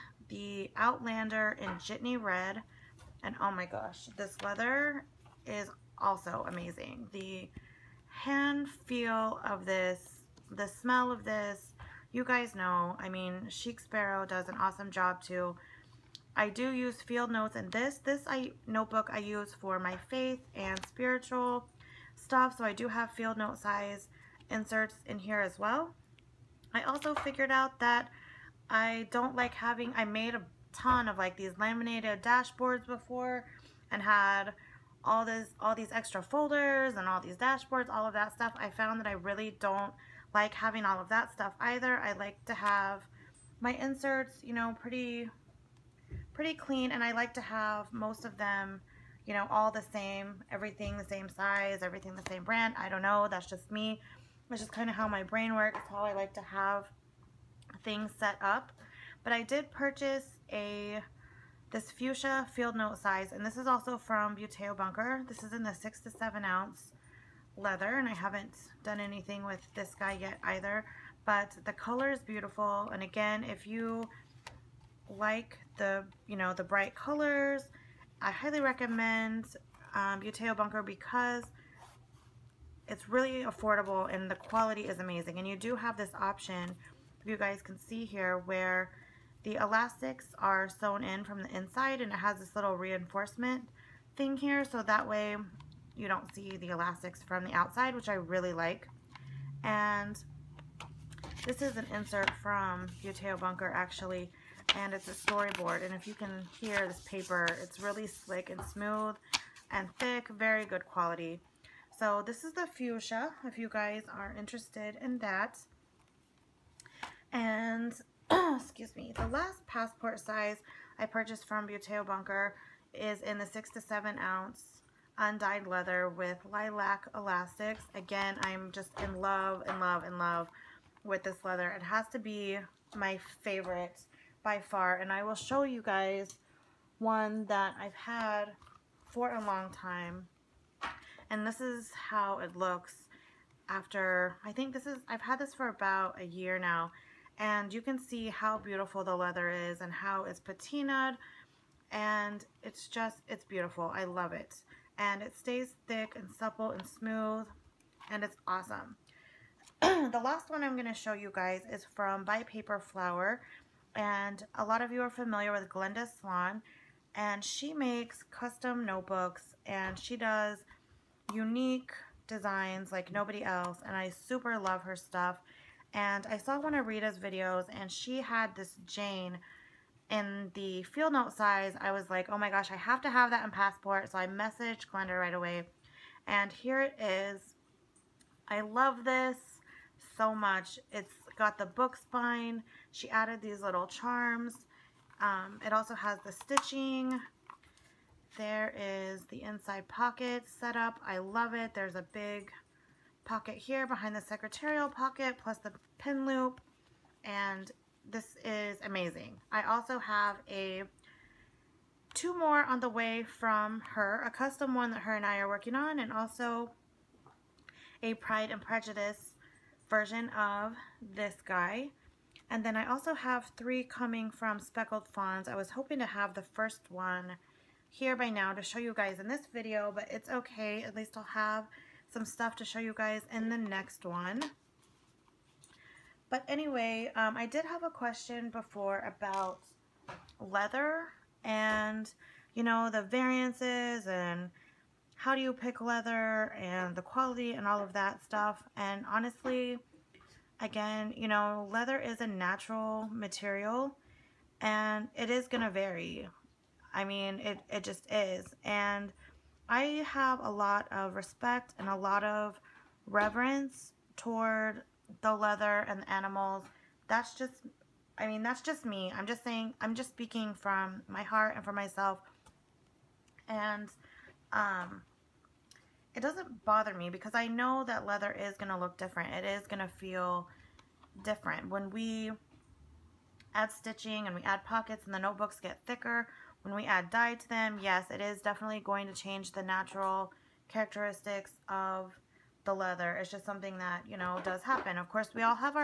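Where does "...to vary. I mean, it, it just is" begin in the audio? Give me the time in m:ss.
4:15.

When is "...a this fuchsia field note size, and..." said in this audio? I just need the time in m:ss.
1:00.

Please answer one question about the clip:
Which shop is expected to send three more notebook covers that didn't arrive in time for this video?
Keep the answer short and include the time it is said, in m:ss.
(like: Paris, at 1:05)
Speckled Fawns, at 3:44.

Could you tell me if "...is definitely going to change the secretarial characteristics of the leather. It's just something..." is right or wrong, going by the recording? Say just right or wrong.
wrong.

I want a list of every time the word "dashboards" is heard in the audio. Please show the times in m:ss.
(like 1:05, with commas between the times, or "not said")
0:32, 0:37.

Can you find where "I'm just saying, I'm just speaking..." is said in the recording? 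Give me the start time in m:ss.
4:29.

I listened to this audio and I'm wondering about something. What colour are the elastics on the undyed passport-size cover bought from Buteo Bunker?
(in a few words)
lilac.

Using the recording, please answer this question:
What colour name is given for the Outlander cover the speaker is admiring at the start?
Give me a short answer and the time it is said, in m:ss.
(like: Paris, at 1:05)
Jitney Red, at 0:01.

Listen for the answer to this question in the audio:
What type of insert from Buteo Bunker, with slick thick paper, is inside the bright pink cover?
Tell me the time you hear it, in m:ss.
1:45.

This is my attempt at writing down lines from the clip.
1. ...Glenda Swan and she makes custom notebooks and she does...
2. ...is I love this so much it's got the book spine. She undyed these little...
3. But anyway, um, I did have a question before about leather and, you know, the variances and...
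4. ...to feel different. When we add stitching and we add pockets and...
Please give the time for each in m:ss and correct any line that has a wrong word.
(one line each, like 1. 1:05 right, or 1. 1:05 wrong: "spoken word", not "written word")
1. 2:45 right
2. 3:07 wrong: "added", not "undyed"
3. 3:56 right
4. 4:39 right.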